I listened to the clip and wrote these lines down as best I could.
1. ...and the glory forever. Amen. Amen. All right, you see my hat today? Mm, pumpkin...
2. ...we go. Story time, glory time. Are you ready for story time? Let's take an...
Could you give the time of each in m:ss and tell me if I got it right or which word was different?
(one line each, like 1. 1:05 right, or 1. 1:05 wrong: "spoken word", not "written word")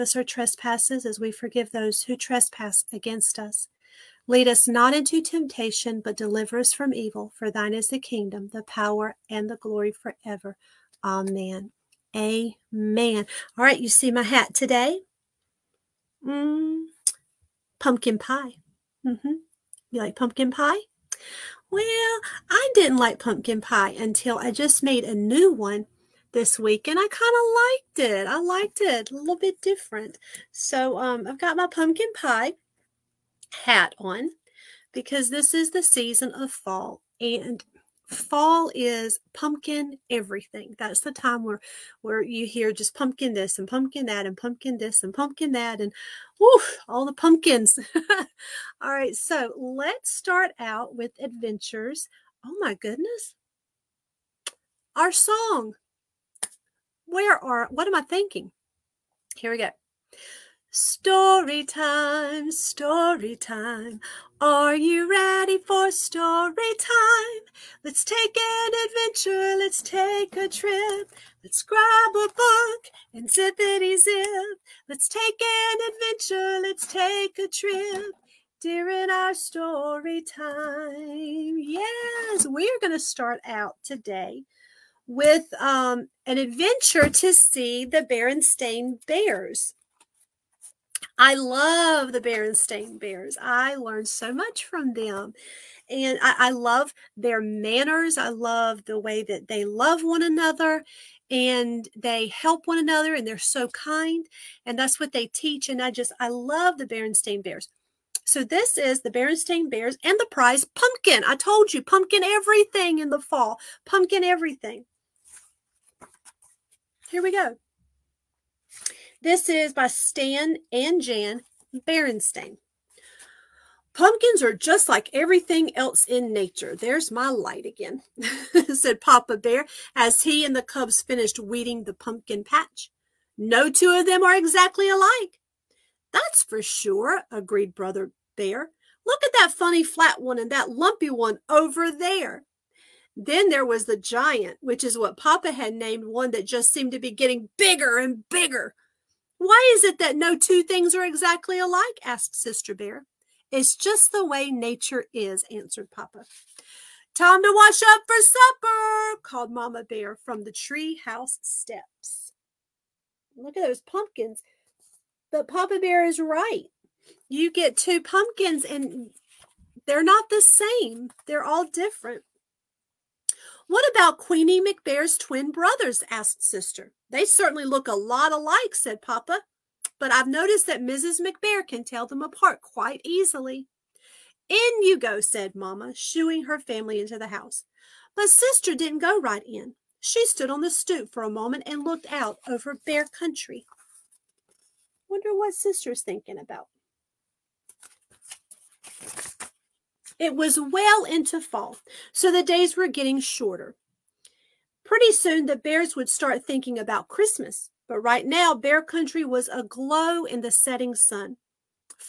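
1. 0:09 right
2. 0:59 wrong: "story", not "glory".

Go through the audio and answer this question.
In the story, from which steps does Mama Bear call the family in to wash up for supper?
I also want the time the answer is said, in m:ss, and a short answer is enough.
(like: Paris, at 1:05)
The tree house steps, at 2:40.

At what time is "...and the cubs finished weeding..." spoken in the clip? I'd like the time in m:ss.
2:10.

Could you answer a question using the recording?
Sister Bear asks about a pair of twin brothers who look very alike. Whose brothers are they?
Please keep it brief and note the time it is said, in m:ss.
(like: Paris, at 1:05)
Queenie McBear, at 2:54.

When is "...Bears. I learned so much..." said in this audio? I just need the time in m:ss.
1:32.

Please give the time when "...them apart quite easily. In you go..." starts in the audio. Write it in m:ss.
3:02.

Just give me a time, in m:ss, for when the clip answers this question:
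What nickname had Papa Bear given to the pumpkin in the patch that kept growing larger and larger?
2:23.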